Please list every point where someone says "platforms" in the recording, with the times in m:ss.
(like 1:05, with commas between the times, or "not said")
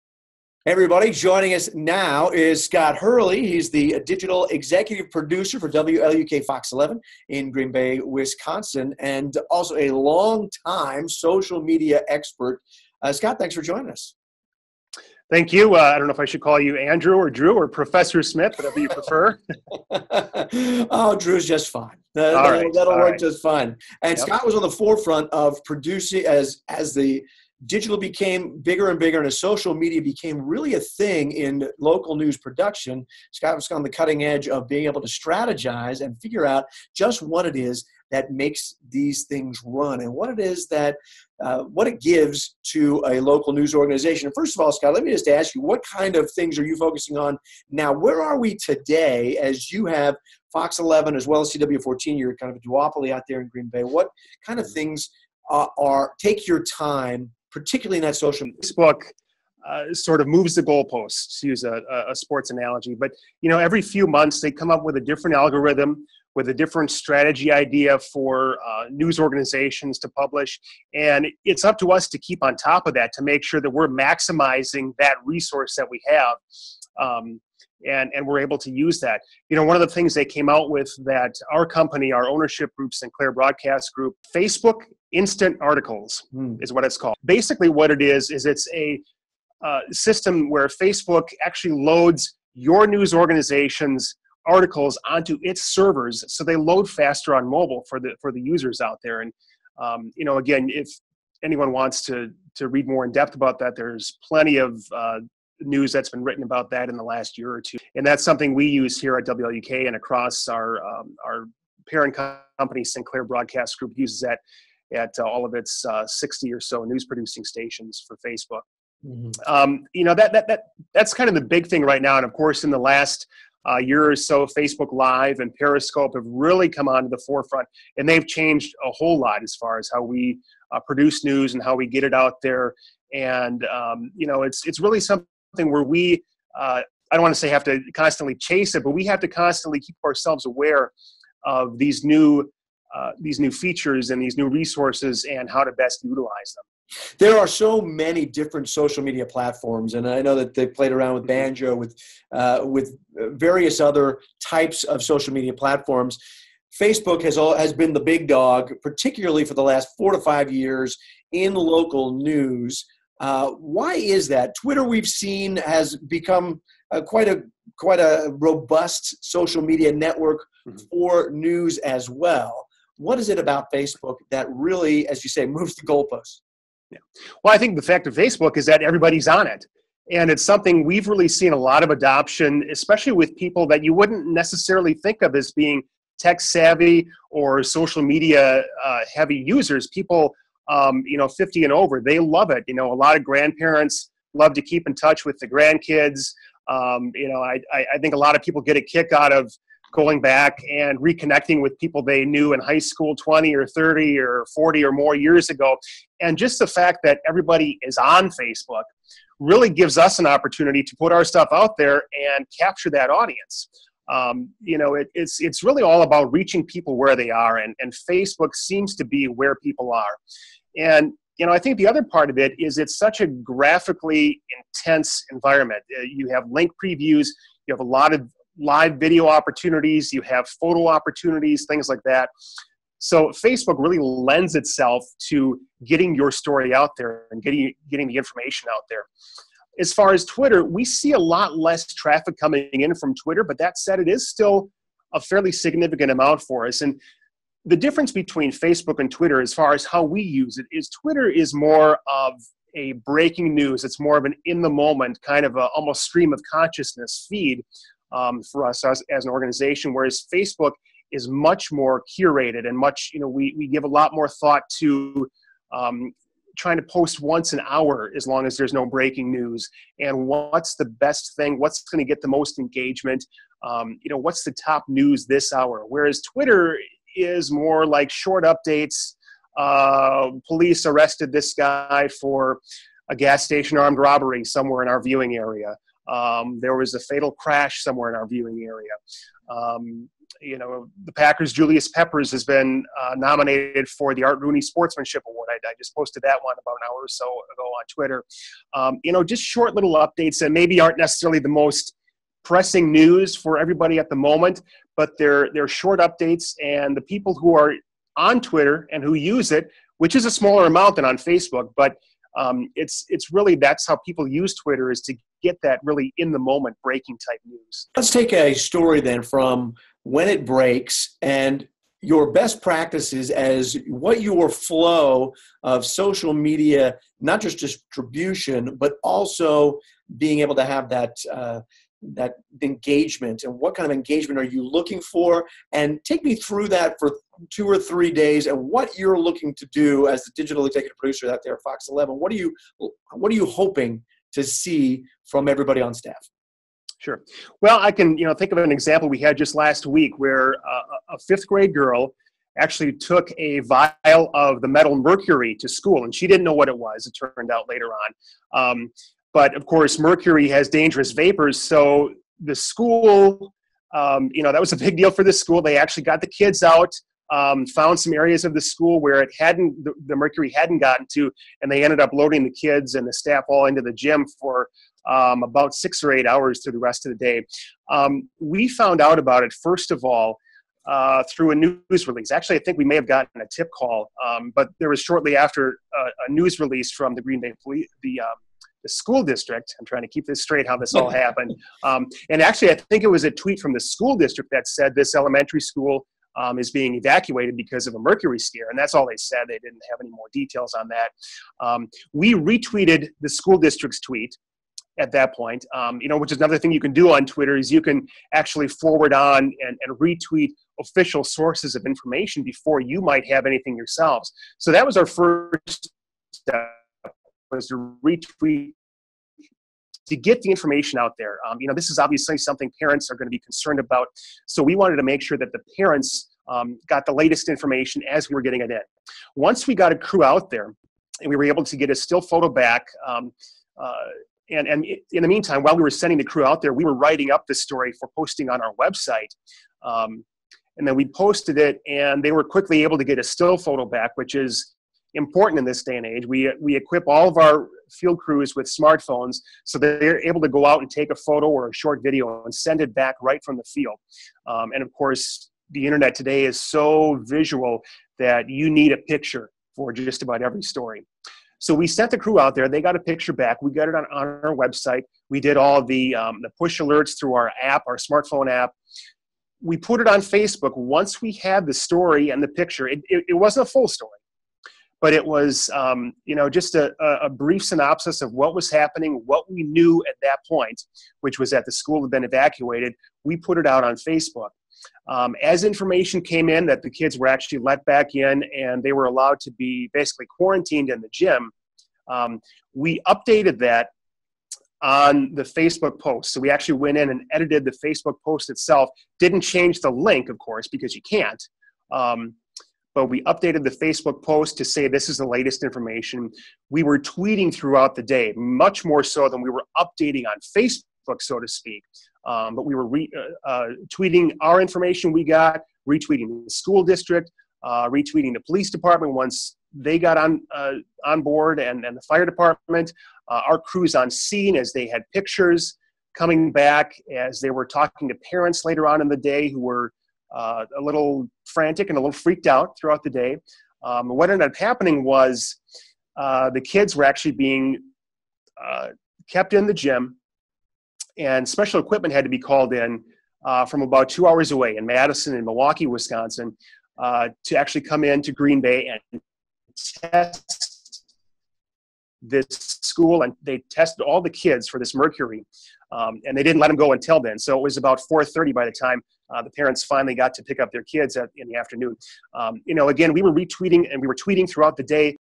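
2:29, 2:35.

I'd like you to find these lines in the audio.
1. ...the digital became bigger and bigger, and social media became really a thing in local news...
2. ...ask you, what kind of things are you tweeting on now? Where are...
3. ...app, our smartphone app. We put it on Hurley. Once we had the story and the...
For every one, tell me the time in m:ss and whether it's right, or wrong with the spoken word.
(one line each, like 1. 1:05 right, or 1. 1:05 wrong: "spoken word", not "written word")
1. 0:26 right
2. 0:45 wrong: "focusing", not "tweeting"
3. 7:47 wrong: "Facebook", not "Hurley".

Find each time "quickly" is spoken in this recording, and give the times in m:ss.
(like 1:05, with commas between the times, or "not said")
7:22.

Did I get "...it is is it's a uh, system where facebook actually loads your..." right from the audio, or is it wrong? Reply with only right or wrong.
right.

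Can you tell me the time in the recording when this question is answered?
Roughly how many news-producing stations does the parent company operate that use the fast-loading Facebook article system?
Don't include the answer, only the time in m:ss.
1:56.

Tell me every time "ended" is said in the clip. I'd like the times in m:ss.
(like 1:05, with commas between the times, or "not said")
6:11, 8:54.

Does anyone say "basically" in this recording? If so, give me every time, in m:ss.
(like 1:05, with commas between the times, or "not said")
1:27, 8:09.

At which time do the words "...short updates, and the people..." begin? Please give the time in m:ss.
5:05.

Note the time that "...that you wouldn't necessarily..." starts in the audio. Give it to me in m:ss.
3:03.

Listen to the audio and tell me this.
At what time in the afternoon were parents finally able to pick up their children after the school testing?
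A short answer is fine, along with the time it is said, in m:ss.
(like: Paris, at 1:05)
4:30, at 9:18.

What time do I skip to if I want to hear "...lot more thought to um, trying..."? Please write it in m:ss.
4:23.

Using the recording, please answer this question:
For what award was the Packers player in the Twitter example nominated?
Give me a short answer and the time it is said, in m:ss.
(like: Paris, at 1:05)
Art Rooney Sportsmanship Award, at 4:54.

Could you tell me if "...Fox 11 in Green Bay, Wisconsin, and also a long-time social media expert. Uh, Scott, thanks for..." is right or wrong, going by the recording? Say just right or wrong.
right.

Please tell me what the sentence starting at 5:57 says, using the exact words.
It turned out later on, um, but of course, mercury has dangerous vapors, so the school.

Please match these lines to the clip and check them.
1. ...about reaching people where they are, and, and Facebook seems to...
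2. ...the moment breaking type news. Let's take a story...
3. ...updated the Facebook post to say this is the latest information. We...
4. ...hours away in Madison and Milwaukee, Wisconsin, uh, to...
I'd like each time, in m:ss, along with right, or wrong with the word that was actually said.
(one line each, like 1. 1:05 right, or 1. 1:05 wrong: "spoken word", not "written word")
1. 3:36 right
2. 5:16 right
3. 8:23 right
4. 9:04 right.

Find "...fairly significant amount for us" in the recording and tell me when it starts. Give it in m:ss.
4:05.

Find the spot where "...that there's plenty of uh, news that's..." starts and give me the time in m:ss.
1:43.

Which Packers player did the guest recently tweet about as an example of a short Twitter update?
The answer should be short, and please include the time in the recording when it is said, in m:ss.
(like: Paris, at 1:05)
Julius Peppers, at 4:51.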